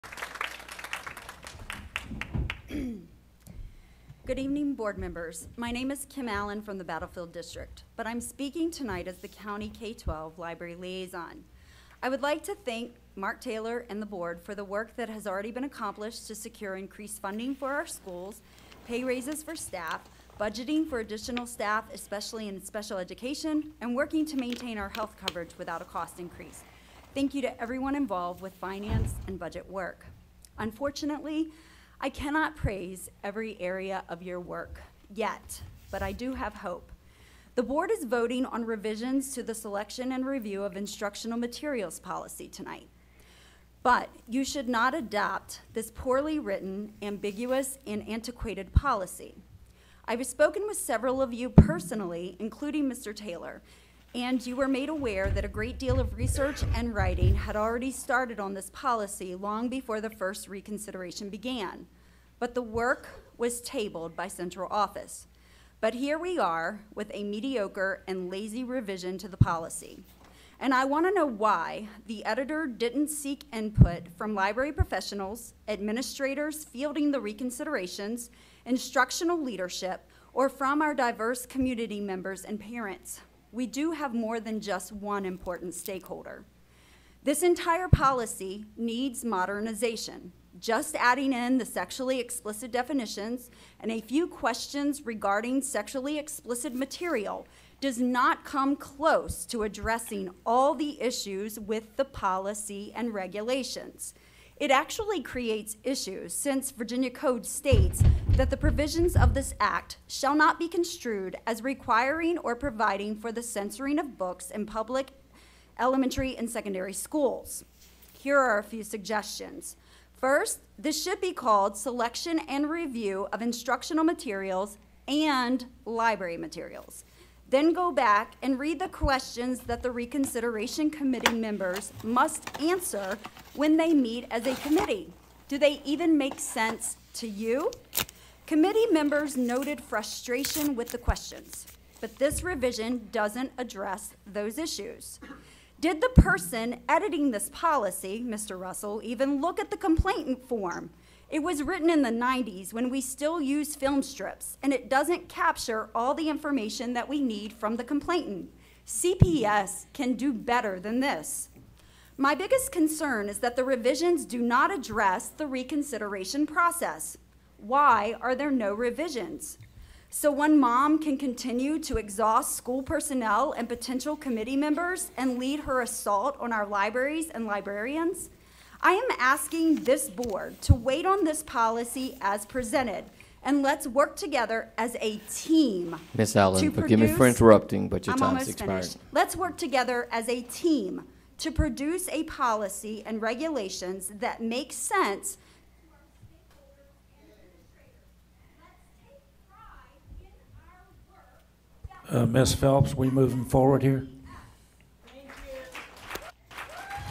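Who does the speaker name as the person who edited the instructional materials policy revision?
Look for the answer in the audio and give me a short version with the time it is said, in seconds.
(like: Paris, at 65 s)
Mr. Russell, at 148 s.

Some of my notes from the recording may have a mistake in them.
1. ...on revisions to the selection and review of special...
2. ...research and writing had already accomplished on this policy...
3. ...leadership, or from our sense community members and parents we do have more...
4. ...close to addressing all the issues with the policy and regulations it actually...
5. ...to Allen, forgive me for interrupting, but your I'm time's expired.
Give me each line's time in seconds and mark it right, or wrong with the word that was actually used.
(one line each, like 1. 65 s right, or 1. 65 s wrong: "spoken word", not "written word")
1. 38 s wrong: "instructional", not "special"
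2. 56 s wrong: "started", not "accomplished"
3. 79 s wrong: "diverse", not "sense"
4. 98 s right
5. 186 s right.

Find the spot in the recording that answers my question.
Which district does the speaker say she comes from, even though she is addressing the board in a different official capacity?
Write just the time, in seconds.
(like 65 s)
6 s.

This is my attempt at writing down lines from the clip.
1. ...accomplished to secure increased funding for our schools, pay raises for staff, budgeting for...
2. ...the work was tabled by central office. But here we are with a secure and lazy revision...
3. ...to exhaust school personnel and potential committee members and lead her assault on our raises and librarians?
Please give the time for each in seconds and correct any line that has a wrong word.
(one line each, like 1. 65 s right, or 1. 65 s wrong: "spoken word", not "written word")
1. 15 s right
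2. 62 s wrong: "mediocre", not "secure"
3. 171 s wrong: "libraries", not "raises".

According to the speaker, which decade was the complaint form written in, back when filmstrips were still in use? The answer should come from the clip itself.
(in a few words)
the 90s.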